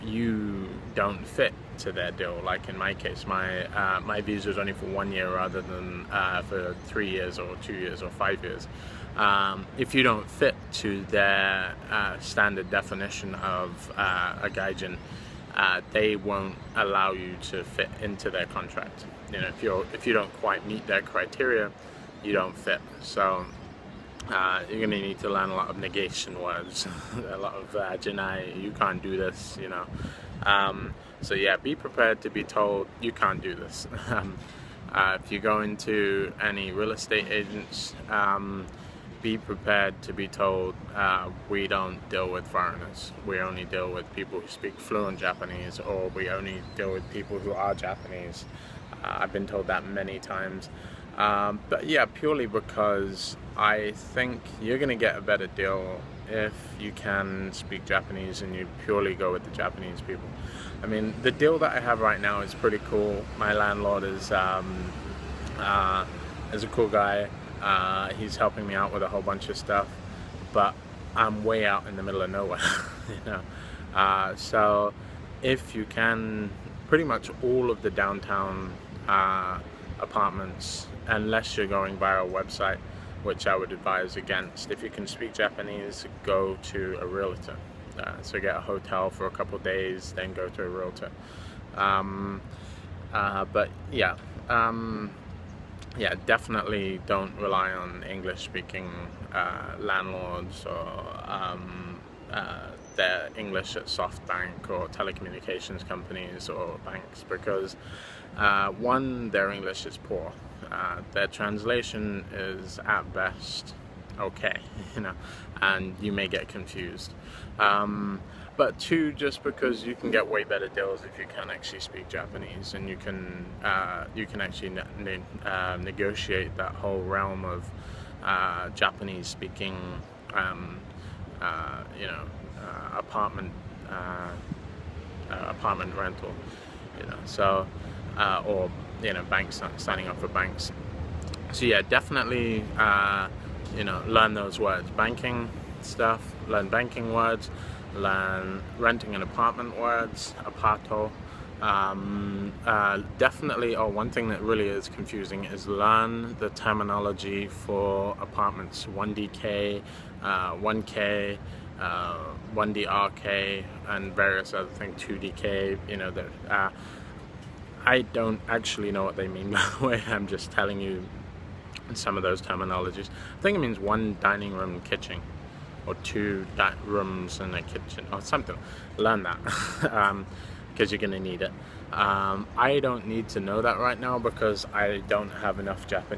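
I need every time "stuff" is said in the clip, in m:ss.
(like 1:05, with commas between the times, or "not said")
1:09, 2:25.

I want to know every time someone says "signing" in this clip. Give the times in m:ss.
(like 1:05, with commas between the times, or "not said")
2:19.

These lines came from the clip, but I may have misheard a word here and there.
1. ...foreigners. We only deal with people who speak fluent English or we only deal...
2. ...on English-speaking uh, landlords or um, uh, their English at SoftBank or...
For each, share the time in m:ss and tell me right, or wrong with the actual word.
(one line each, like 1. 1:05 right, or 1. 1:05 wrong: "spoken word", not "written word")
1. 0:42 wrong: "Japanese", not "English"
2. 1:37 right.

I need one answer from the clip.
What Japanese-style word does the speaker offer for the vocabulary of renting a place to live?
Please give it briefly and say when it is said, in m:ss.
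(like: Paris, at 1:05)
aparto, at 2:30.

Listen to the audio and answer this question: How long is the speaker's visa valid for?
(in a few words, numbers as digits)
1 year.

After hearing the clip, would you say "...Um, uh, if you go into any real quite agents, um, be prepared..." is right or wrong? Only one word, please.
wrong.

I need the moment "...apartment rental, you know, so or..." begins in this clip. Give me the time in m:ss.
2:15.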